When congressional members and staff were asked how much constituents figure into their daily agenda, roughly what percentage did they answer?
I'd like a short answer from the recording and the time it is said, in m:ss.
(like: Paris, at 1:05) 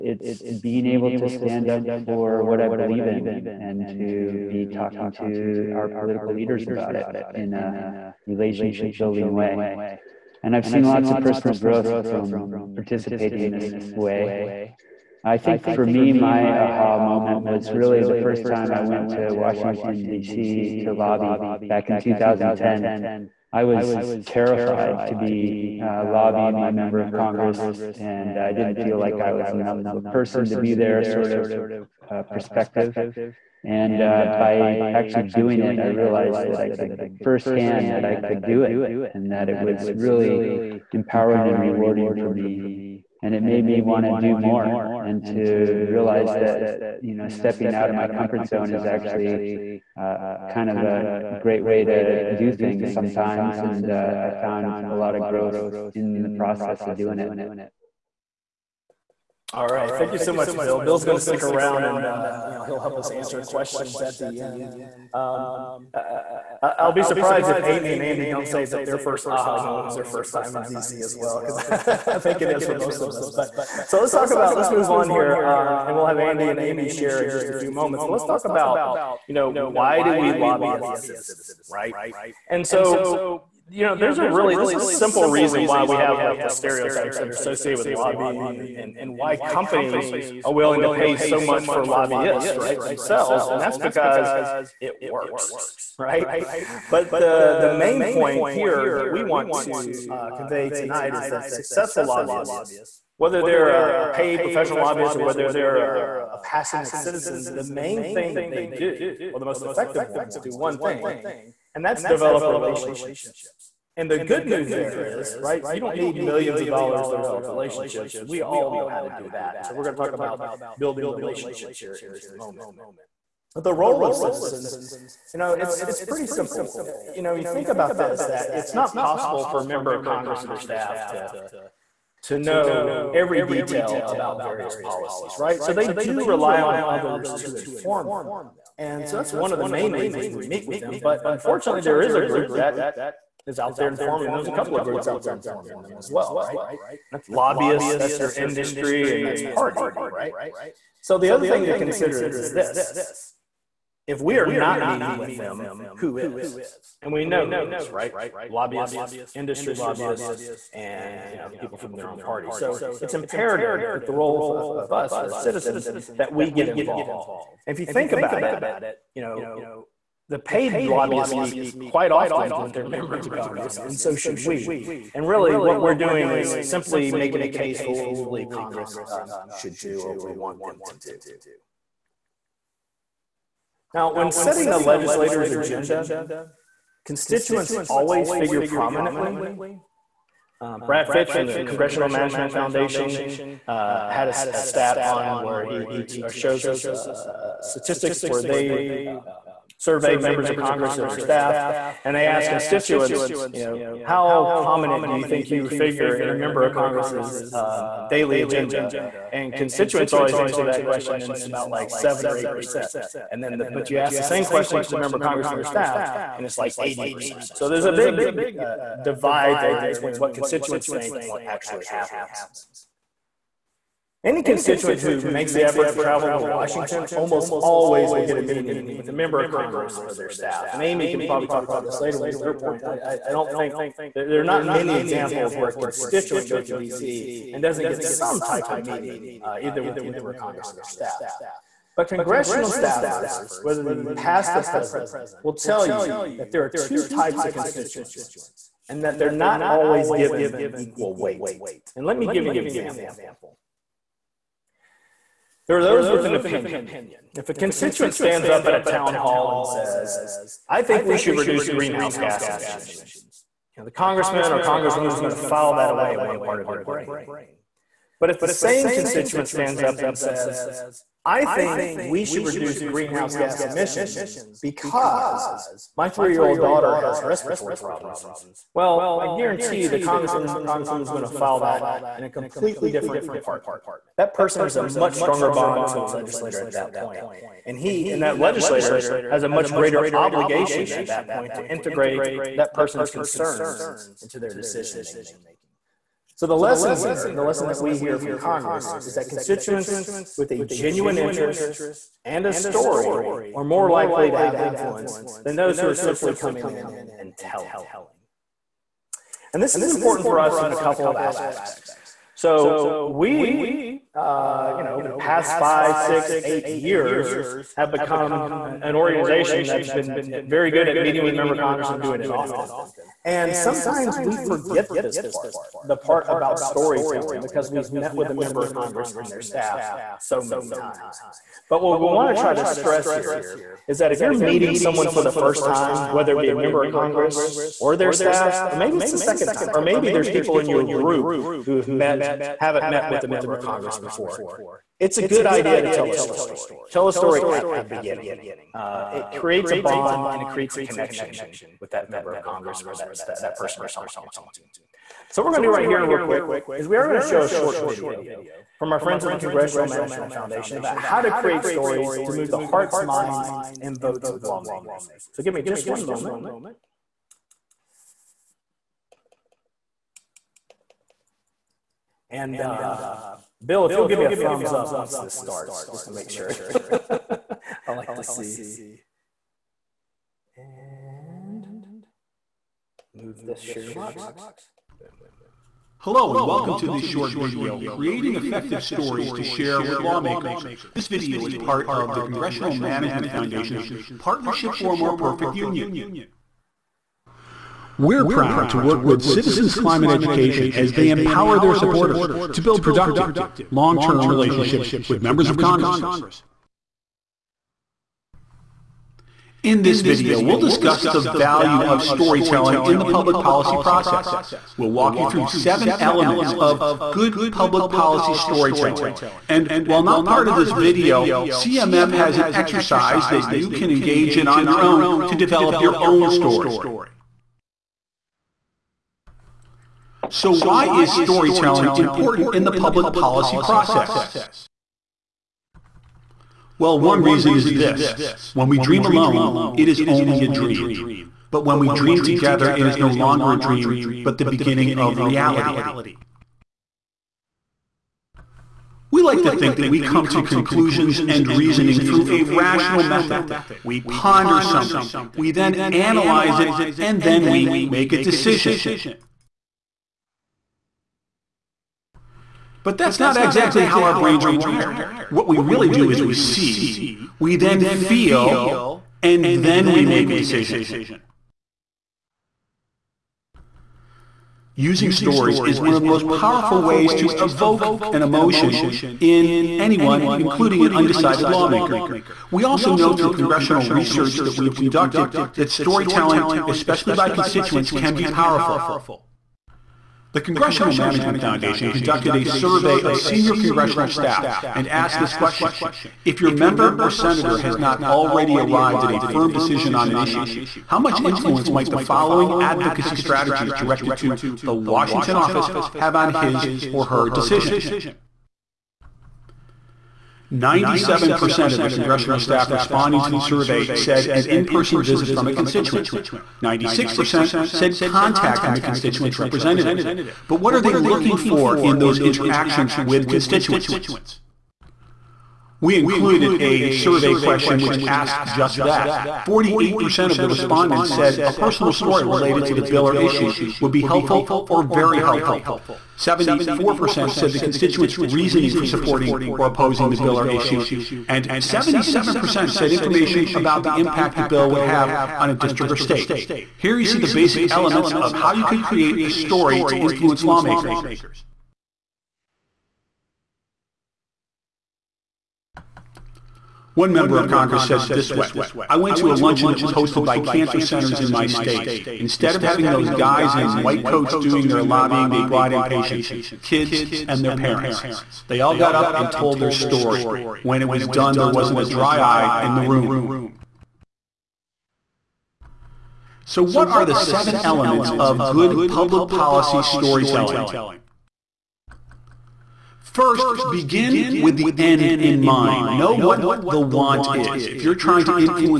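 80%, at 3:36.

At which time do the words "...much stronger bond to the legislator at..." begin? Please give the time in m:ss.
4:44.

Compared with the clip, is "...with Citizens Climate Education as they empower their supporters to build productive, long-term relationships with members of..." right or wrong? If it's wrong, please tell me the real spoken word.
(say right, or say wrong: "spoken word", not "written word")
right.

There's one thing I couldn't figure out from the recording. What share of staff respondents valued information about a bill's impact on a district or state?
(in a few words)
77%.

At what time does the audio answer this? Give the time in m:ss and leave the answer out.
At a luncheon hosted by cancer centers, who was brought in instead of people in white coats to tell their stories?
9:25.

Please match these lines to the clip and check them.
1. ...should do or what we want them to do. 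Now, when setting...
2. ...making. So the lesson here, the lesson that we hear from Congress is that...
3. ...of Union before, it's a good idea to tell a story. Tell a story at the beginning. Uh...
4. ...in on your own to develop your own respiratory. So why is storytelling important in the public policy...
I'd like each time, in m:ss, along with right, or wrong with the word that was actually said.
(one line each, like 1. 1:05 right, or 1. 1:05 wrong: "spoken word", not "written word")
1. 2:59 right
2. 4:55 right
3. 5:43 wrong: "Congress", not "Union"
4. 7:04 wrong: "story", not "respiratory".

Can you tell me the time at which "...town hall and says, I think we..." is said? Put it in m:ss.
4:18.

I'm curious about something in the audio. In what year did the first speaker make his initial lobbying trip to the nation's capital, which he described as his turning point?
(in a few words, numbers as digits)
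2010.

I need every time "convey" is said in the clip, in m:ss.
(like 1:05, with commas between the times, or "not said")
1:40.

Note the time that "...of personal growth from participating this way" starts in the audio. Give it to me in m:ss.
0:11.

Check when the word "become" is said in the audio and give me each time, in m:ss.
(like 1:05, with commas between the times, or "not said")
5:17.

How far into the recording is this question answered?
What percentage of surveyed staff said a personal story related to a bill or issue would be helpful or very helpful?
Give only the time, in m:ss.
8:49.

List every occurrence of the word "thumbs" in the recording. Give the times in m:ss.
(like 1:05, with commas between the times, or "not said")
6:14.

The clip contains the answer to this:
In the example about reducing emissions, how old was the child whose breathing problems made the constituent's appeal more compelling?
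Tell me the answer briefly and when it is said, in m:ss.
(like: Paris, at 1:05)
3, at 4:36.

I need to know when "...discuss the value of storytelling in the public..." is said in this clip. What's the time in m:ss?
6:50.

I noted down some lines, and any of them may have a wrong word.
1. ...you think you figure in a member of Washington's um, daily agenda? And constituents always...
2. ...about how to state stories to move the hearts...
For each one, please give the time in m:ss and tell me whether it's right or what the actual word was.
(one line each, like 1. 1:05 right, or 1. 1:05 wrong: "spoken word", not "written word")
1. 3:25 wrong: "Congress", not "Washington"
2. 6:00 wrong: "create", not "state".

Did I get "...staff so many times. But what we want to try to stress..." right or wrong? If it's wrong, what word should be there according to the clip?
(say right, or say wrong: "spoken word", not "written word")
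right.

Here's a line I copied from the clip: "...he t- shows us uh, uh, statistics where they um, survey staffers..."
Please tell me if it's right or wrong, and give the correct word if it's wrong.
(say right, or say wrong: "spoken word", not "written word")
wrong: "members", not "staffers".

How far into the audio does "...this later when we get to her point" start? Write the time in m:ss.
3:51.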